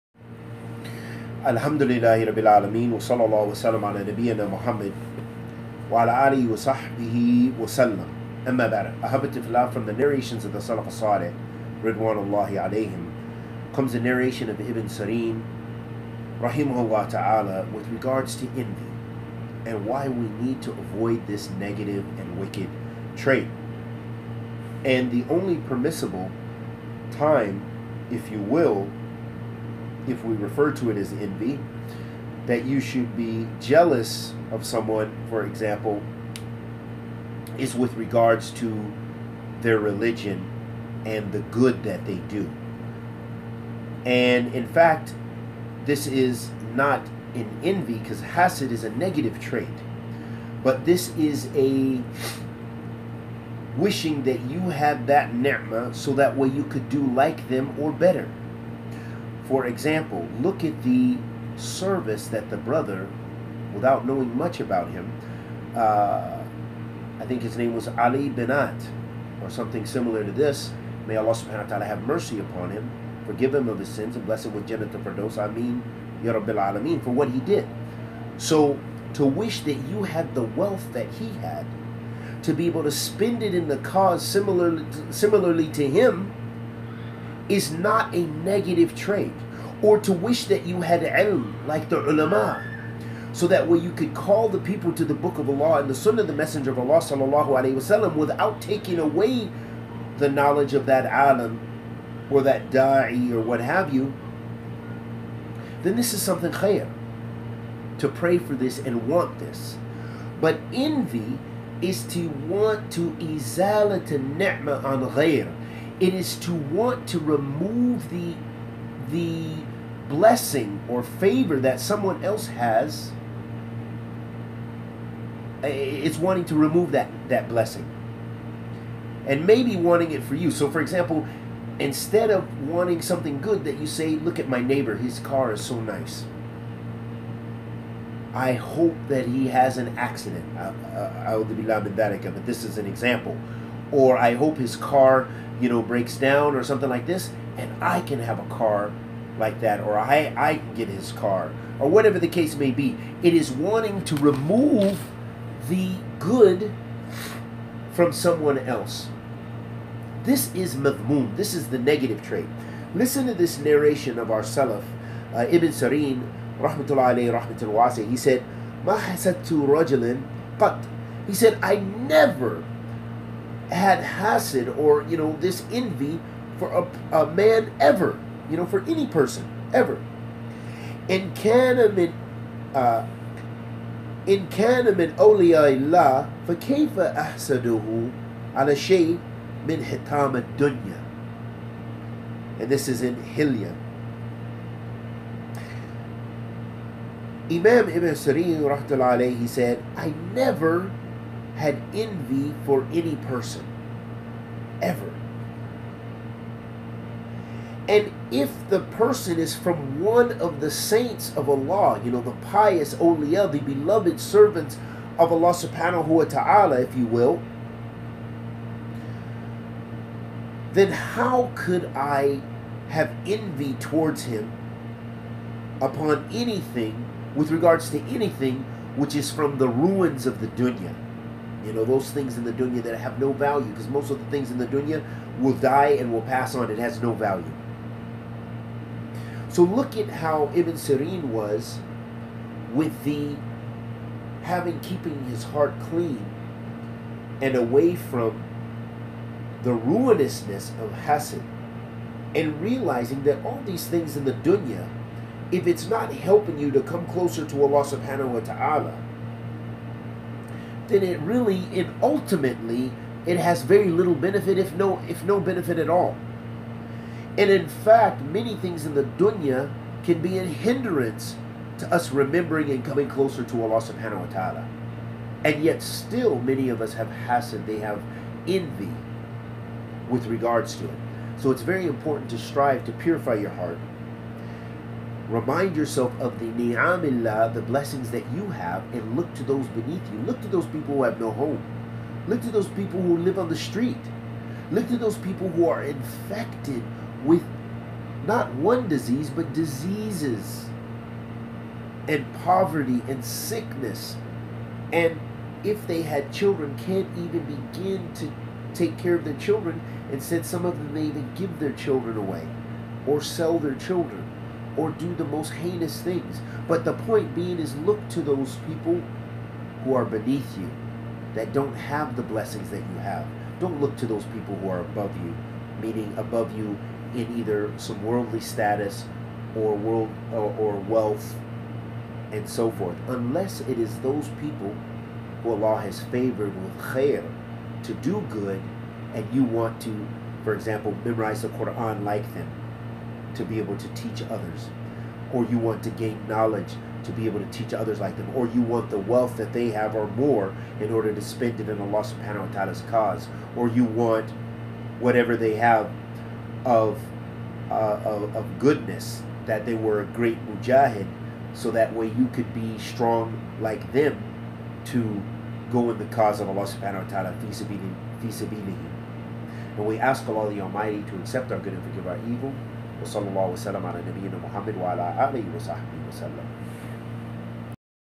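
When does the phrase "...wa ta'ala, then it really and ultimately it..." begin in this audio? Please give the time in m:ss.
4:18.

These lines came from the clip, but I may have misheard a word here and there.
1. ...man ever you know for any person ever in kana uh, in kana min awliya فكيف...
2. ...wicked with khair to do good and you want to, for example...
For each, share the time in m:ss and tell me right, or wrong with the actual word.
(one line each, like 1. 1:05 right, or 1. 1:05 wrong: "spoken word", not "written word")
1. 2:57 right
2. 5:36 wrong: "favored", not "wicked".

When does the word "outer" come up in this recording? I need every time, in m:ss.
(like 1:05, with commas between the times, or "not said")
not said.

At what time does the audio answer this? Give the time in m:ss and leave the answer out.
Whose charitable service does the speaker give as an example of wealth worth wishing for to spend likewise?
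1:07.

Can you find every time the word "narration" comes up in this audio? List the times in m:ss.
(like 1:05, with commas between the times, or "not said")
0:09, 0:13, 2:43.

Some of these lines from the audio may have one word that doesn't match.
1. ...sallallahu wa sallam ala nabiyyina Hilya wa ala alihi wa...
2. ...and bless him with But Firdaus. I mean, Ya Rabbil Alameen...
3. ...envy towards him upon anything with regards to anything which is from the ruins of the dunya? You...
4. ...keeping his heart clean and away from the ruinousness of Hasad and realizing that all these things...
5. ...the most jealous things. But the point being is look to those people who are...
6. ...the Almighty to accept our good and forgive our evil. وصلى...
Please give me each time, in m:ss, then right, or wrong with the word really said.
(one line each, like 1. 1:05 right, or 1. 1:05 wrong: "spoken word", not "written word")
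1. 0:02 wrong: "Muhammad", not "Hilya"
2. 1:14 wrong: "Jannah", not "But"
3. 3:43 right
4. 4:04 right
5. 5:15 wrong: "heinous", not "jealous"
6. 6:10 right.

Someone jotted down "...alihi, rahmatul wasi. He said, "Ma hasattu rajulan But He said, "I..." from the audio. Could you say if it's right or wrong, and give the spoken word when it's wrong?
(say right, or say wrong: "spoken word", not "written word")
wrong: "alayhi", not "alihi".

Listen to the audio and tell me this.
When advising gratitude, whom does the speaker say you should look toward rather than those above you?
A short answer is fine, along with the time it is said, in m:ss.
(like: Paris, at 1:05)
Those beneath you, at 4:49.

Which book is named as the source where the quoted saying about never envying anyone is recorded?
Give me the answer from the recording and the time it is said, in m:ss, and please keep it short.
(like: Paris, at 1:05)
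Hilya, at 3:13.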